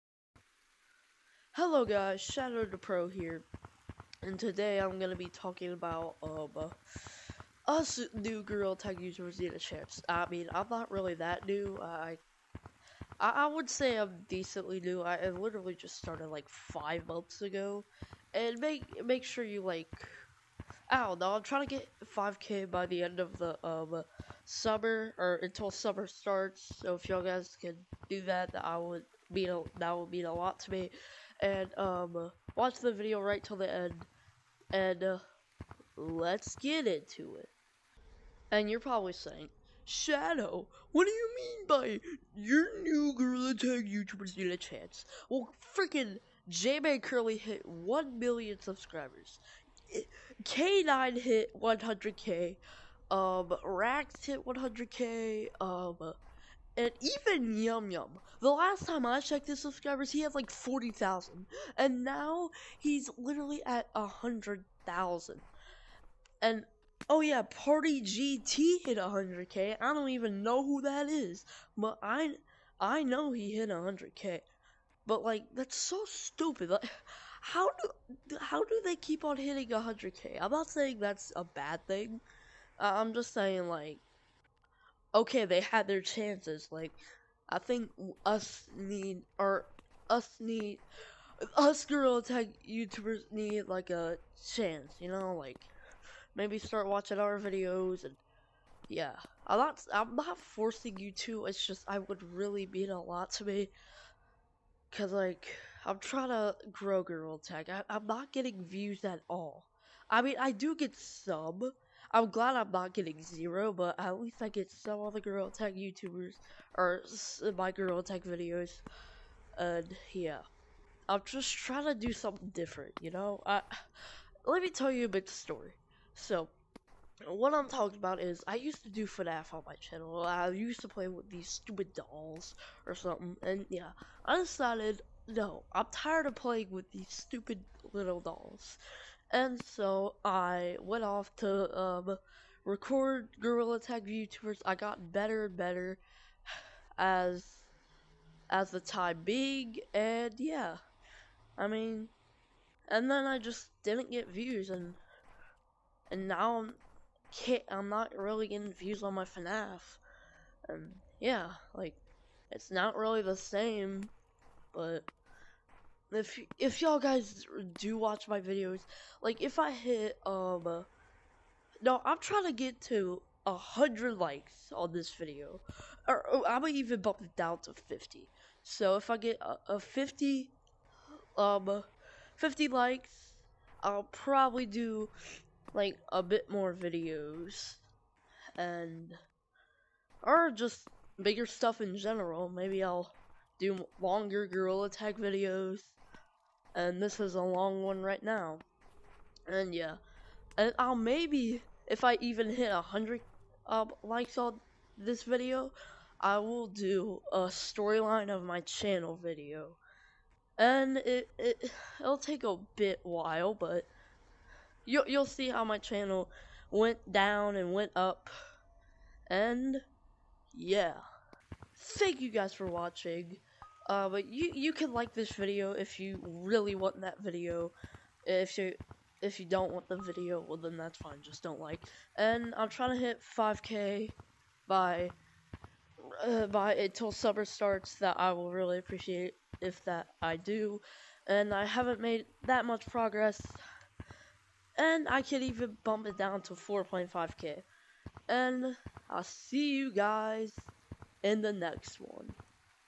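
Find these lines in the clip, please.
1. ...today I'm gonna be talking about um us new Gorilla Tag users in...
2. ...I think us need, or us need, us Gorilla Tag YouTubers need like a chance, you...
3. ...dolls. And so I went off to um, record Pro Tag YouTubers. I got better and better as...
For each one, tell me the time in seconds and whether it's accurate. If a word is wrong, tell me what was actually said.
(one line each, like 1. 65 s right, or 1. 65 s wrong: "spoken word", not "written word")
1. 4 s right
2. 87 s right
3. 138 s wrong: "Gorilla", not "Pro".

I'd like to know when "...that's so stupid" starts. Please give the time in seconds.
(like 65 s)
75 s.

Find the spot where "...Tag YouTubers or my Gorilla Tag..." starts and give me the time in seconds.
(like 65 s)
115 s.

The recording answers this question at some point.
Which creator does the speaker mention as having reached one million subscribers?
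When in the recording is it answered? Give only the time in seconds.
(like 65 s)
46 s.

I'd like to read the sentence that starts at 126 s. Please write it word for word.
So, what I'm talking about is I used to do FNAF on my channel.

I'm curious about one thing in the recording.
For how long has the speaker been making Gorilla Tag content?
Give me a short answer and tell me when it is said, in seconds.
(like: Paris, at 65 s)
5 months, at 16 s.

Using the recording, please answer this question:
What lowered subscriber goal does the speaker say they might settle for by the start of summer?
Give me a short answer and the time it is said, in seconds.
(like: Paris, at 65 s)
4.5K, at 246 s.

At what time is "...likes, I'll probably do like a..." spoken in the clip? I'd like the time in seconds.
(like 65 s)
182 s.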